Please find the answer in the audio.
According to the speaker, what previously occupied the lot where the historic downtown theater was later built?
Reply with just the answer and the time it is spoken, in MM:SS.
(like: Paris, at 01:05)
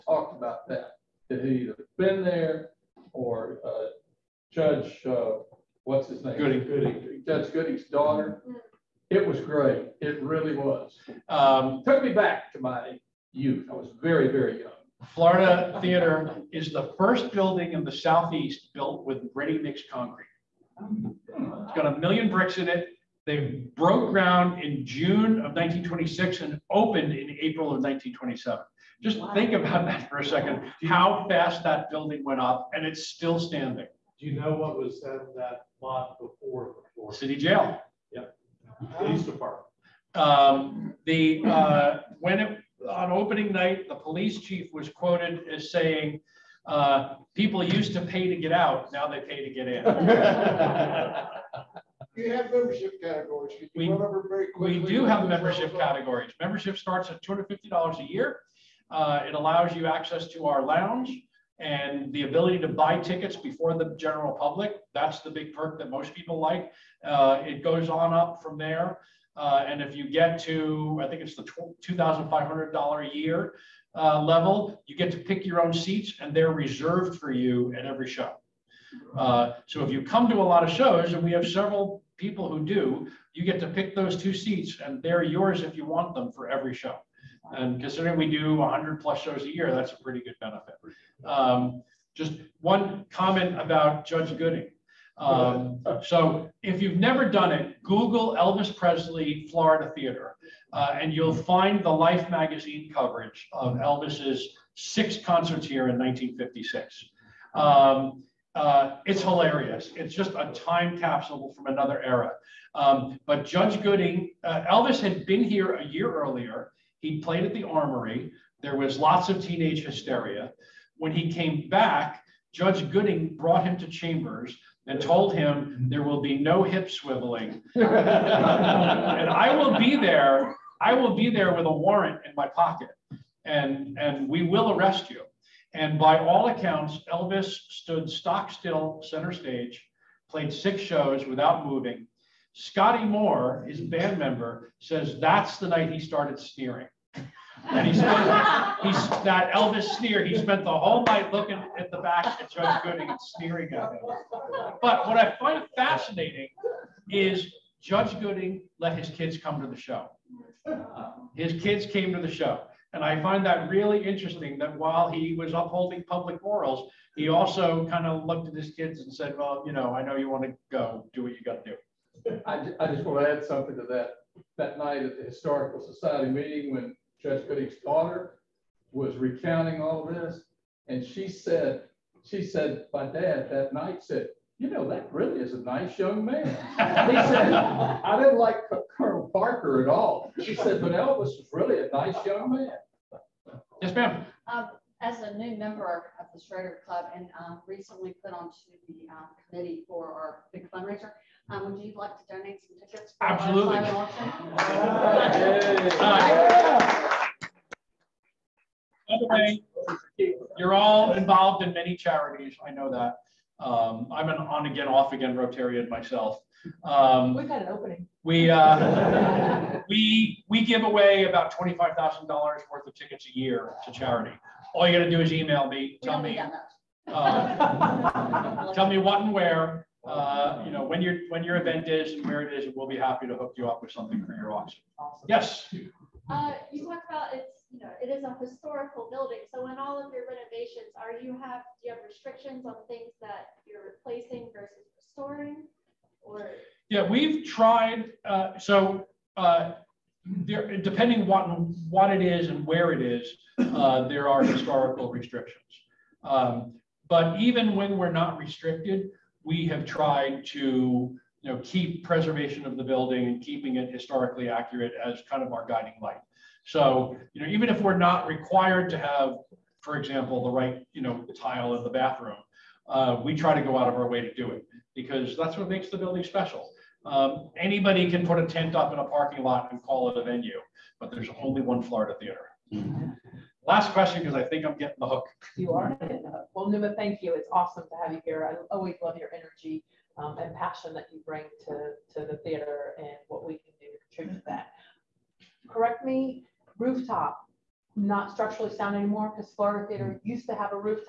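City jail, at 00:37.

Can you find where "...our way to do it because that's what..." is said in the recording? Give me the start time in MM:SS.
04:33.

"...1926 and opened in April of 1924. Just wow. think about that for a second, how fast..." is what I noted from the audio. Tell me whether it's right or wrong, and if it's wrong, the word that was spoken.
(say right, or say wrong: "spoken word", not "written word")
wrong: "1927", not "1924".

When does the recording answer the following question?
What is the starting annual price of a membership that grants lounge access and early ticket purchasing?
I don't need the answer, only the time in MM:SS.
00:57.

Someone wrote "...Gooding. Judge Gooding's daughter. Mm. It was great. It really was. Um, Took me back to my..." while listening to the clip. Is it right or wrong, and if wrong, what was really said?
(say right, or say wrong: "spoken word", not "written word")
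right.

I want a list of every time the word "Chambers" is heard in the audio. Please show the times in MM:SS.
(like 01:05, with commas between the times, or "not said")
02:03.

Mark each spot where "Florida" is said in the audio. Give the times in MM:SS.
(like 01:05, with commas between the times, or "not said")
00:15, 01:39, 04:41, 04:59.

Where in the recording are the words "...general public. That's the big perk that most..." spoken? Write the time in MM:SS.
01:03.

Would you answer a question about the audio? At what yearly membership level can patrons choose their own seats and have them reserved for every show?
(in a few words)
$2,500.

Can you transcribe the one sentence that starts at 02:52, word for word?
I, I just want to add something to that.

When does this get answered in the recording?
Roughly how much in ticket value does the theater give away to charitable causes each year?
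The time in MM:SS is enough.
03:41.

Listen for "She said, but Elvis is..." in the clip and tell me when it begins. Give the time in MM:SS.
03:10.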